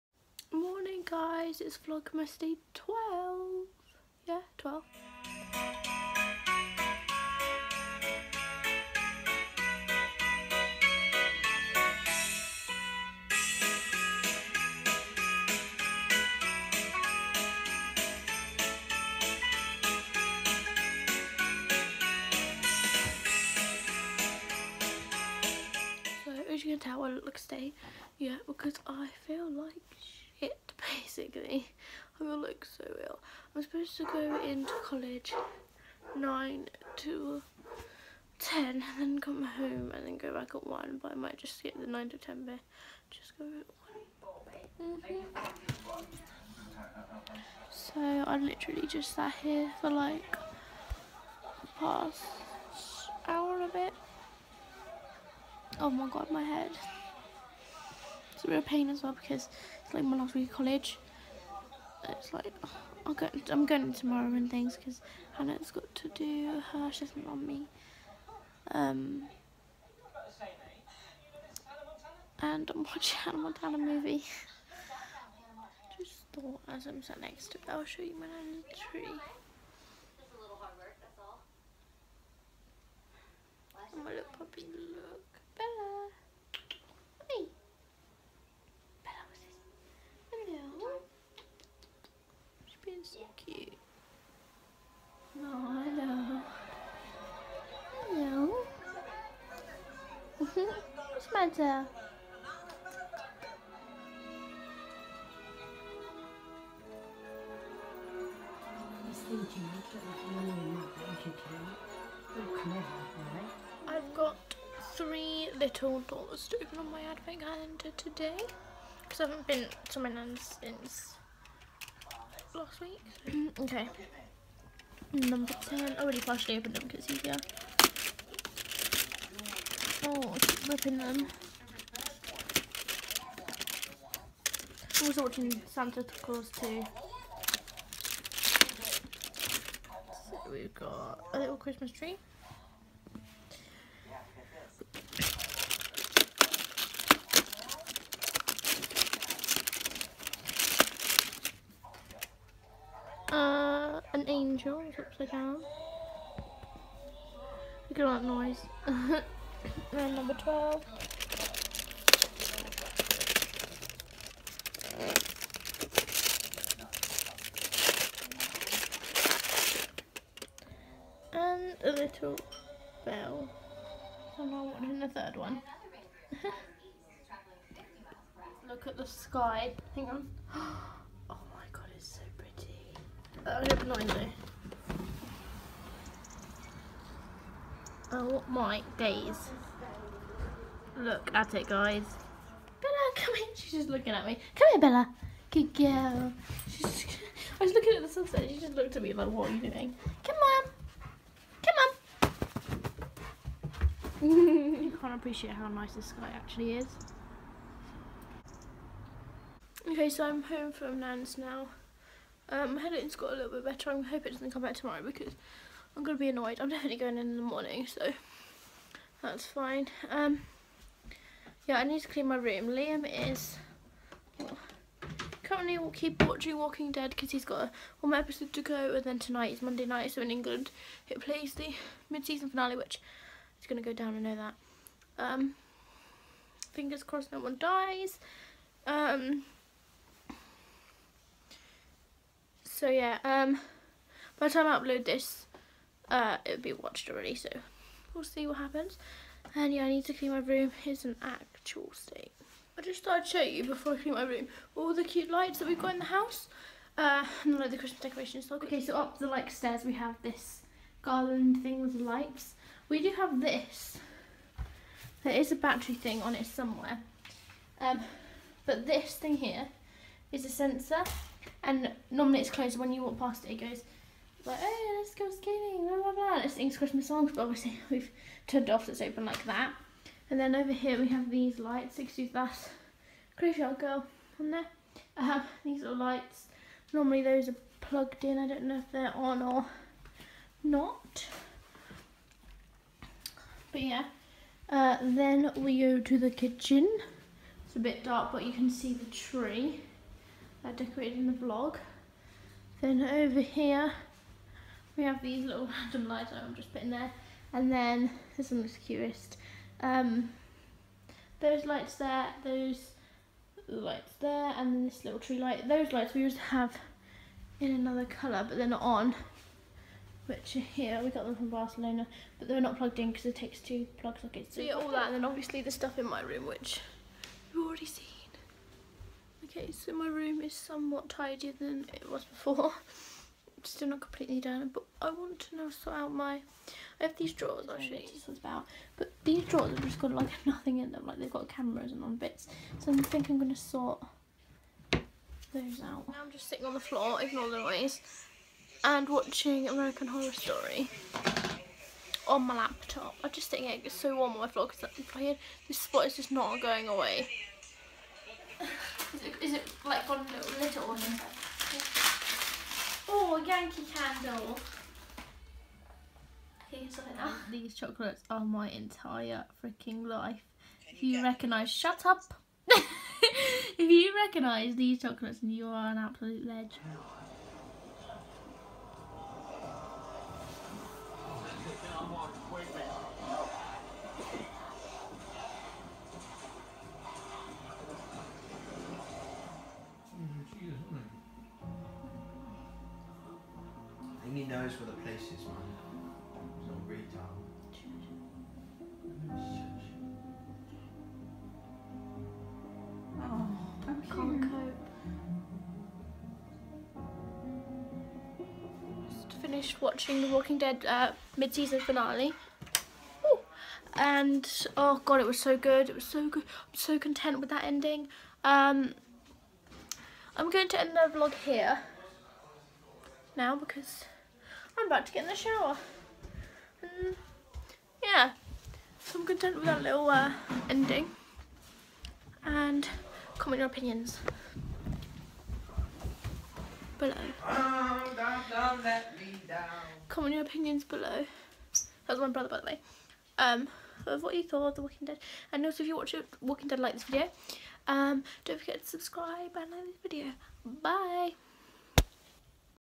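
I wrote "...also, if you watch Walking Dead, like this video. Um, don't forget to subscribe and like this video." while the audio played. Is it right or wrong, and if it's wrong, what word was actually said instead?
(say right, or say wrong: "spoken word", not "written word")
right.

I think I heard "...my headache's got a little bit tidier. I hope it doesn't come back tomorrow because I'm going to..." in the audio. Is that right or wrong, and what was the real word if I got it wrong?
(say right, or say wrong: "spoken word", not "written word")
wrong: "better", not "tidier".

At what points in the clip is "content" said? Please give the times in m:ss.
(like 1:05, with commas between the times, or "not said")
6:56, 7:09.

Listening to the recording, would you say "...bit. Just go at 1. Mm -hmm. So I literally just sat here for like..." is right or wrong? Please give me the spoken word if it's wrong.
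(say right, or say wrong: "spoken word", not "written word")
right.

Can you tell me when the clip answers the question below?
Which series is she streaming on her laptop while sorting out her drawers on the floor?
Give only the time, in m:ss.
5:49.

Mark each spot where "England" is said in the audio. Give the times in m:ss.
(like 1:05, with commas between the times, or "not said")
3:50.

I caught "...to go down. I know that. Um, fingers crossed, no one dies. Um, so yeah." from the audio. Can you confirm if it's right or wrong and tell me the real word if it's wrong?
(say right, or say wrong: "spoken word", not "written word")
right.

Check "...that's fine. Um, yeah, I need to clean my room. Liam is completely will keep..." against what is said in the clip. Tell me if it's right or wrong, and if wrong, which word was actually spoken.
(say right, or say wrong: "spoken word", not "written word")
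wrong: "currently", not "completely".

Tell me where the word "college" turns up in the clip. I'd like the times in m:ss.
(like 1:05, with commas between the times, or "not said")
0:34, 1:00.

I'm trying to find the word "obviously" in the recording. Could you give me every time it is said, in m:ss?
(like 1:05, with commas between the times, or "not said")
4:37, 5:25.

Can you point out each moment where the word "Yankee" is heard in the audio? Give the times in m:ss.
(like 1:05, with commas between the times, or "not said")
6:03.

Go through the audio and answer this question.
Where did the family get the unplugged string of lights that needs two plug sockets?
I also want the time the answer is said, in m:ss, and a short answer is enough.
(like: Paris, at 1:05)
Barcelona, at 5:21.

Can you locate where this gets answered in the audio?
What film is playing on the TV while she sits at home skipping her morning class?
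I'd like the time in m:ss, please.
1:13.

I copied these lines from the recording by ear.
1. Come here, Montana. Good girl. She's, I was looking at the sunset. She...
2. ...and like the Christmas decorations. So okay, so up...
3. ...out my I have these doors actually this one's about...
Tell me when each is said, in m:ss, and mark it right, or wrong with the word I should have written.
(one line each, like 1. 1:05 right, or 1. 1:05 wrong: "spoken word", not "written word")
1. 3:14 wrong: "Bella", not "Montana"
2. 4:17 right
3. 5:35 wrong: "drawers", not "doors".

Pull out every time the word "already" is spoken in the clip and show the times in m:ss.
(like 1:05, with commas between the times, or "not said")
2:06, 4:07, 5:27.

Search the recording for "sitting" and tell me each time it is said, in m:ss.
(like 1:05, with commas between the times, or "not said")
5:46, 5:53.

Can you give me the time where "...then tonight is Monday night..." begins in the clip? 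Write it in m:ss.
3:49.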